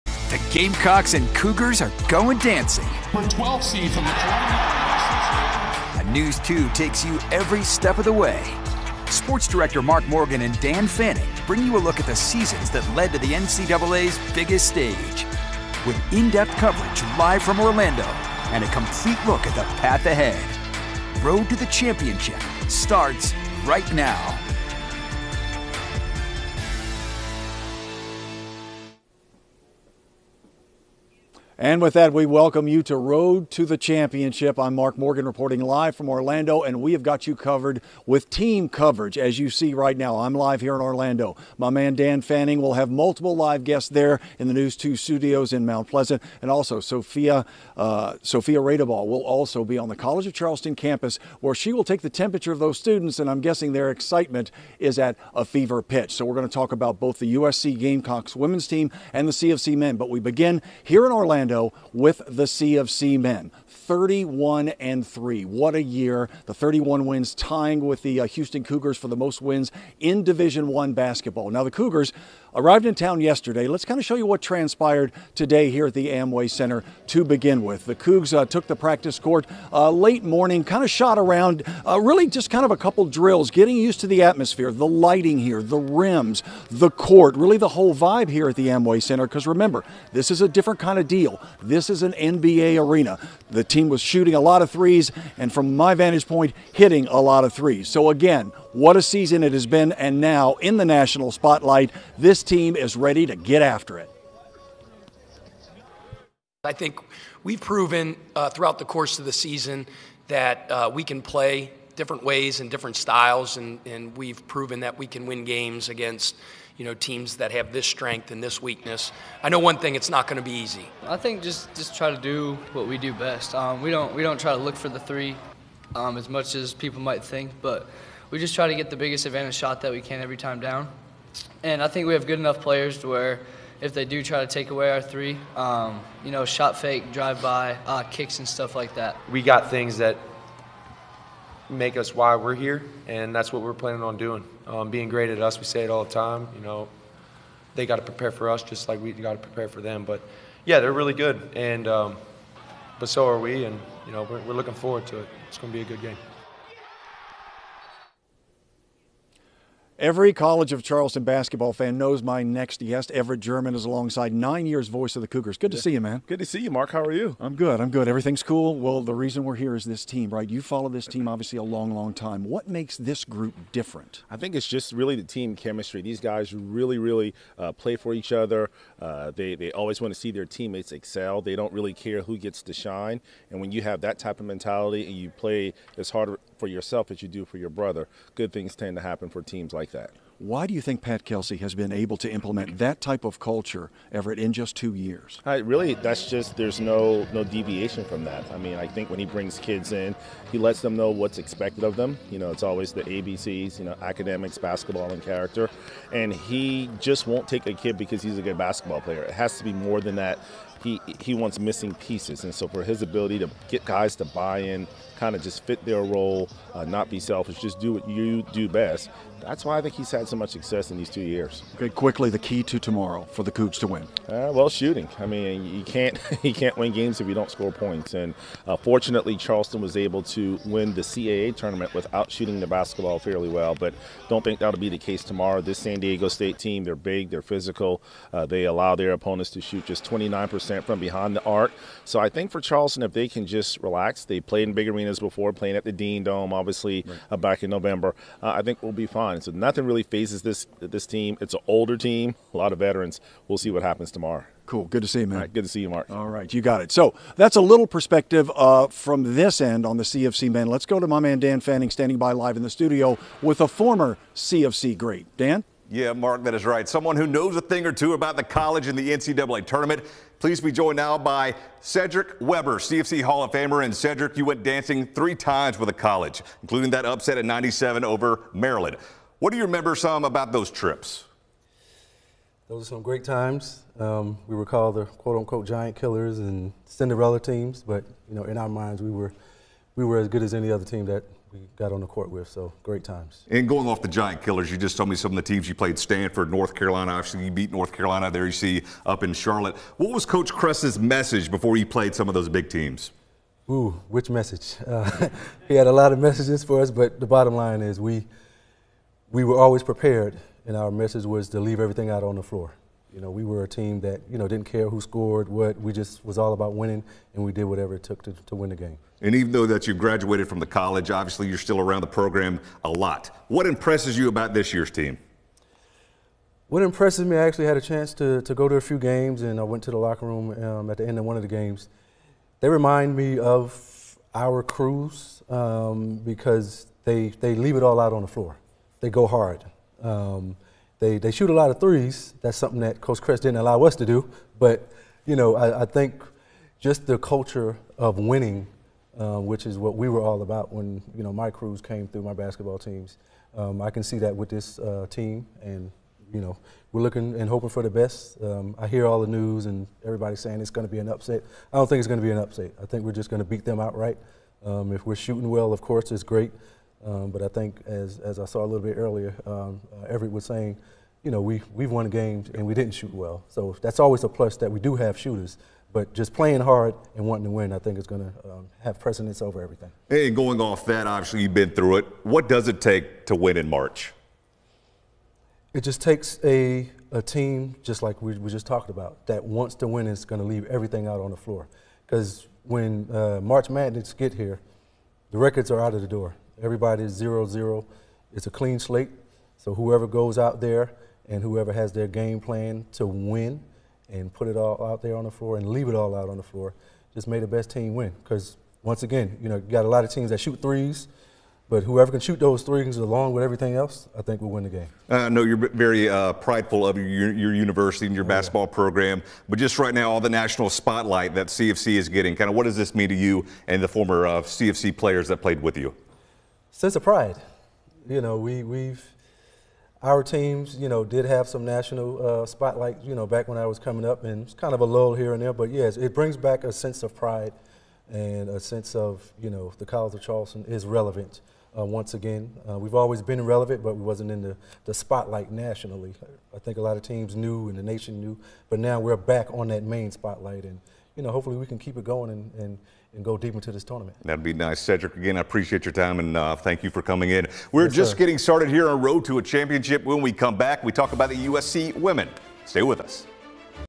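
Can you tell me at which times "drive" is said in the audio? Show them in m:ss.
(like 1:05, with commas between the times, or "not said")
2:17.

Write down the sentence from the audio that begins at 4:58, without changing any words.
There you see up in Charlotte.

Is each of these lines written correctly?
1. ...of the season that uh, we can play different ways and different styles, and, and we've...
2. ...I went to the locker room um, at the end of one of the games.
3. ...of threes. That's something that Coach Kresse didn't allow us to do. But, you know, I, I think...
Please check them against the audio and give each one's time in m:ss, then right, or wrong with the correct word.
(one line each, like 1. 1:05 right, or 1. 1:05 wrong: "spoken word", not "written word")
1. 1:49 right
2. 5:29 right
3. 5:41 right.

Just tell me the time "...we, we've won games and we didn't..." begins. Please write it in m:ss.
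6:11.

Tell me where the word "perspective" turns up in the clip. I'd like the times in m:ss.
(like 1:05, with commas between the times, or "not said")
4:17.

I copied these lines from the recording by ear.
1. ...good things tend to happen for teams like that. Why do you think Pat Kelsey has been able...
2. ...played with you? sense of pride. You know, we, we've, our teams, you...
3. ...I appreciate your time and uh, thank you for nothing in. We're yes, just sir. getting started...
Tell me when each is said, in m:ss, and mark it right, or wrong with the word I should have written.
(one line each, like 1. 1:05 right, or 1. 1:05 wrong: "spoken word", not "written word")
1. 3:08 right
2. 7:05 right
3. 7:35 wrong: "coming", not "nothing".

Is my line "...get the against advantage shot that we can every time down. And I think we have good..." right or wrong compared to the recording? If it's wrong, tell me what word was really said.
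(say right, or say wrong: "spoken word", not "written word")
wrong: "biggest", not "against".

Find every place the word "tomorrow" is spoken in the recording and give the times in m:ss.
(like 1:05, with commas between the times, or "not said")
3:42, 3:55, 4:14.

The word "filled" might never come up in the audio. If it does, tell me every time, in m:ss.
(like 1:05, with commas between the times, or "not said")
not said.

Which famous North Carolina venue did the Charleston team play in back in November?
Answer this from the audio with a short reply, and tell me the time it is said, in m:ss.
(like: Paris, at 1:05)
Dean Dome, at 4:05.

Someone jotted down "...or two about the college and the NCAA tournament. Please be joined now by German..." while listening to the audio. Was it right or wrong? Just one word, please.
wrong.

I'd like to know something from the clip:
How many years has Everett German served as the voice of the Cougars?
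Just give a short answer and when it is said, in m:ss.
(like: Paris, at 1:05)
9, at 2:44.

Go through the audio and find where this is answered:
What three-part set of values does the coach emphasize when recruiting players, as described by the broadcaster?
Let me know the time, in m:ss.
3:23.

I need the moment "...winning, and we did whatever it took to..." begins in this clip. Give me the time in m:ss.
5:16.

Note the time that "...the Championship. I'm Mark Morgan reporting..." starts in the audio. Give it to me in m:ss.
0:33.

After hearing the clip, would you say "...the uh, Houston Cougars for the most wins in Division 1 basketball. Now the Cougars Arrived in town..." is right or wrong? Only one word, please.
right.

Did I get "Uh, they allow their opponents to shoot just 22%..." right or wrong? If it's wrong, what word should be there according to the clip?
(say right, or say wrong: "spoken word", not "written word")
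wrong: "29", not "22".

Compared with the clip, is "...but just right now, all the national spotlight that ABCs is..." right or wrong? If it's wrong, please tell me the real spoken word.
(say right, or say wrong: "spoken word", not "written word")
wrong: "CofC", not "ABCs".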